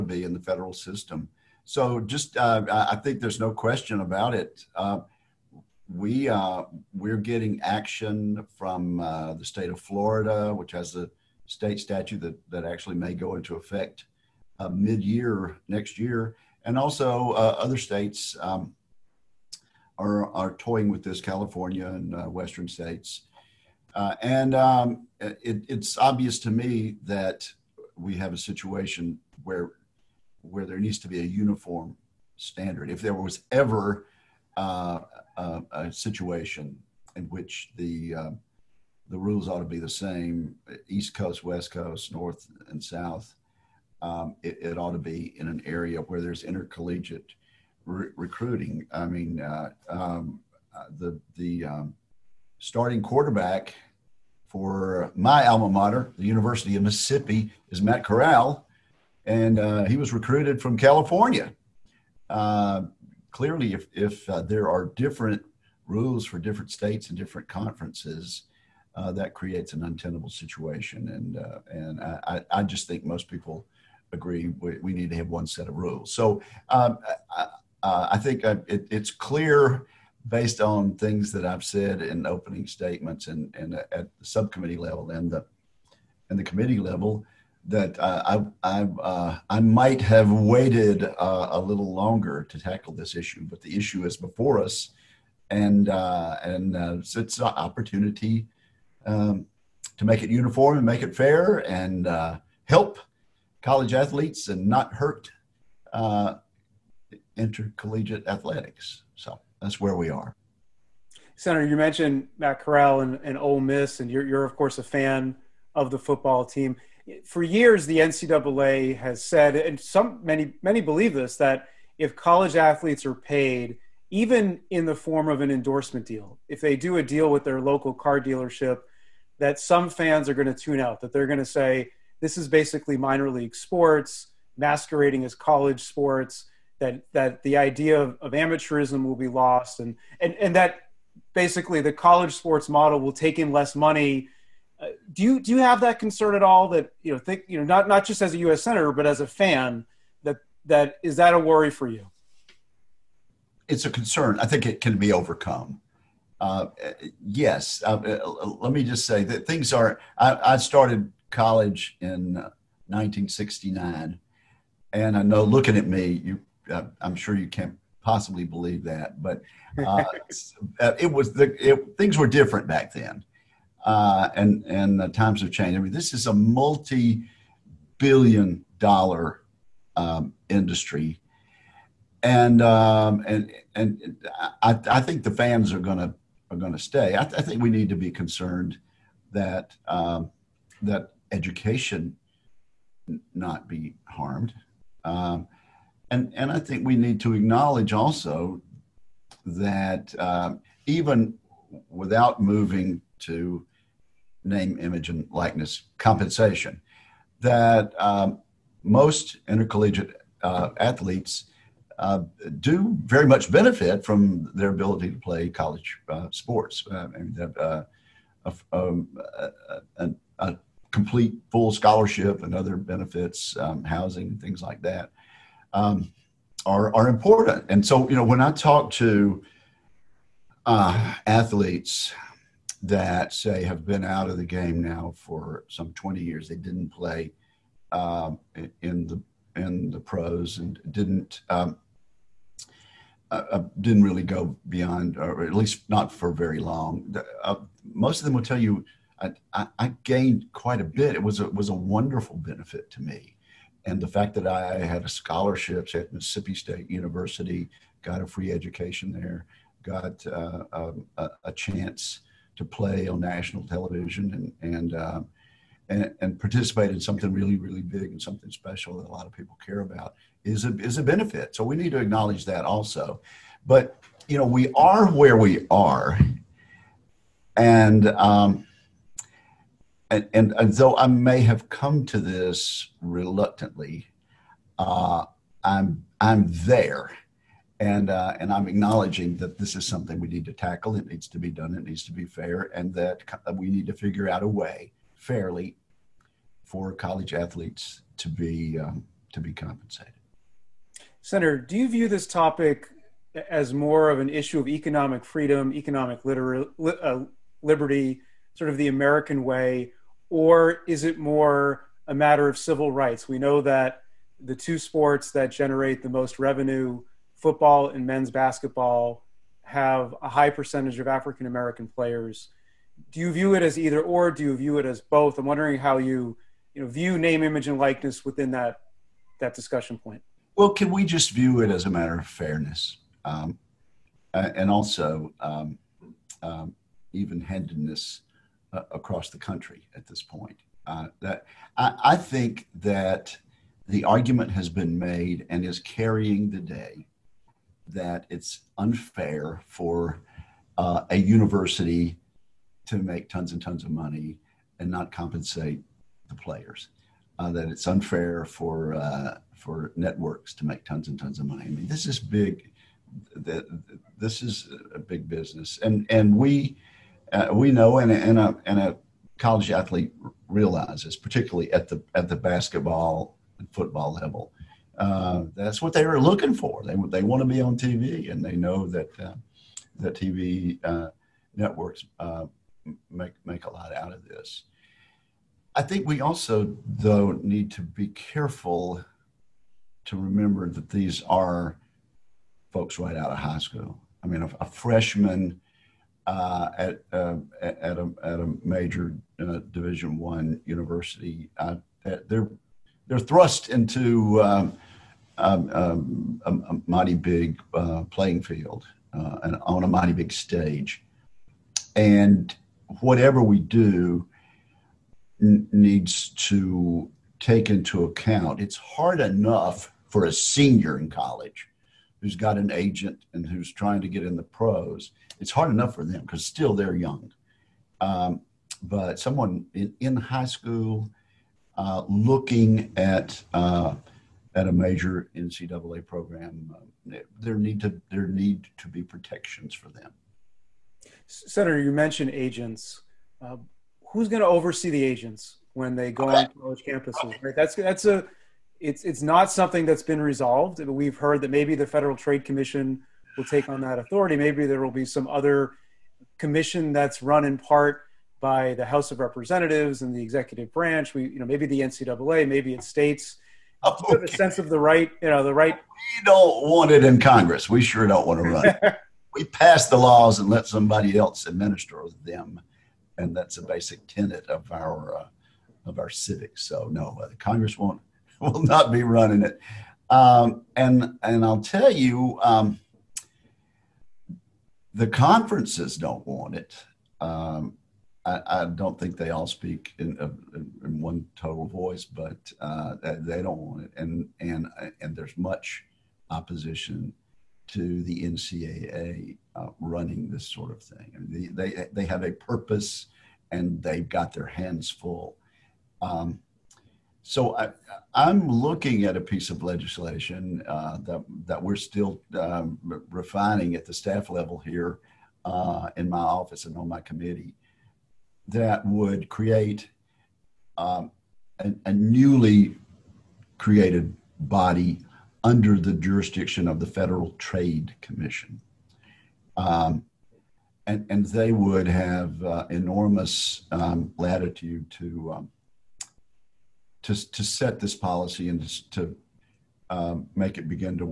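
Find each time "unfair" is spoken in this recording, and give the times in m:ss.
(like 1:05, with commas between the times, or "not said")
5:48, 5:57.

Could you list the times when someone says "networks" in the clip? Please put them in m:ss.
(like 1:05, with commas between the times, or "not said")
5:59, 6:21.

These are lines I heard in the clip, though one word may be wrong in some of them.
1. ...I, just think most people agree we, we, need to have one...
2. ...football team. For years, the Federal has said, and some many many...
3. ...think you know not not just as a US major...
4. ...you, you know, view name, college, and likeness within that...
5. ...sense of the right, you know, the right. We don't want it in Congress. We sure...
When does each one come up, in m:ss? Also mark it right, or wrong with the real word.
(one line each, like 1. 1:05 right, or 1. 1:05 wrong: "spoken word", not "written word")
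1. 1:12 right
2. 1:55 wrong: "NCAA", not "Federal"
3. 2:27 wrong: "senator", not "major"
4. 5:25 wrong: "image", not "college"
5. 7:44 right.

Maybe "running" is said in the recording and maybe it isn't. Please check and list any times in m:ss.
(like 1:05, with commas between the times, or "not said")
7:59, 8:19.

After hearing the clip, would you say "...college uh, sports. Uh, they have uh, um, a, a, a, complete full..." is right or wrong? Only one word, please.
right.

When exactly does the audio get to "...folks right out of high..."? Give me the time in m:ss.
6:32.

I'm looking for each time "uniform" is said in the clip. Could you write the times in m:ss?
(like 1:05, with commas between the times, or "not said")
0:31, 1:40.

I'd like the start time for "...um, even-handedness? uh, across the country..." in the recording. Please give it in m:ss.
5:36.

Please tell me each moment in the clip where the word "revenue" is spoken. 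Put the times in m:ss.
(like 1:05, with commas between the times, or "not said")
5:16.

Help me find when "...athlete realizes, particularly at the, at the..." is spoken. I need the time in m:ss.
6:09.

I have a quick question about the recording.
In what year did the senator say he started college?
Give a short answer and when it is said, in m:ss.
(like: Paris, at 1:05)
1969, at 2:42.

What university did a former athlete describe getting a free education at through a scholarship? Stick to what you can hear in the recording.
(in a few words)
Mississippi State University.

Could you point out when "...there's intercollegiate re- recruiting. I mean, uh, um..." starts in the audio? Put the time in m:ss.
0:46.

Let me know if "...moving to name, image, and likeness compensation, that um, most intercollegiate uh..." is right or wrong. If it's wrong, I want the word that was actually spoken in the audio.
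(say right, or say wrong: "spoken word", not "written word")
right.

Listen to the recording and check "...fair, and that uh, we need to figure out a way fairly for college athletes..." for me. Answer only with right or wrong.
right.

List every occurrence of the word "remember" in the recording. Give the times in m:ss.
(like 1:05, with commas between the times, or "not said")
6:30.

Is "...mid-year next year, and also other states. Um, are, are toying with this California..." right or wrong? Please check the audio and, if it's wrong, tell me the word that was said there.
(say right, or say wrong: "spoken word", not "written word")
right.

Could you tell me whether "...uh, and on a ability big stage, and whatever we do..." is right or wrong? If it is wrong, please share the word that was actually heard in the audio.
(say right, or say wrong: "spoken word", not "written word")
wrong: "mighty", not "ability".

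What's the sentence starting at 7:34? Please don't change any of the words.
Maybe there will be some other commission that's run in part by the House of Representatives and the executive branch.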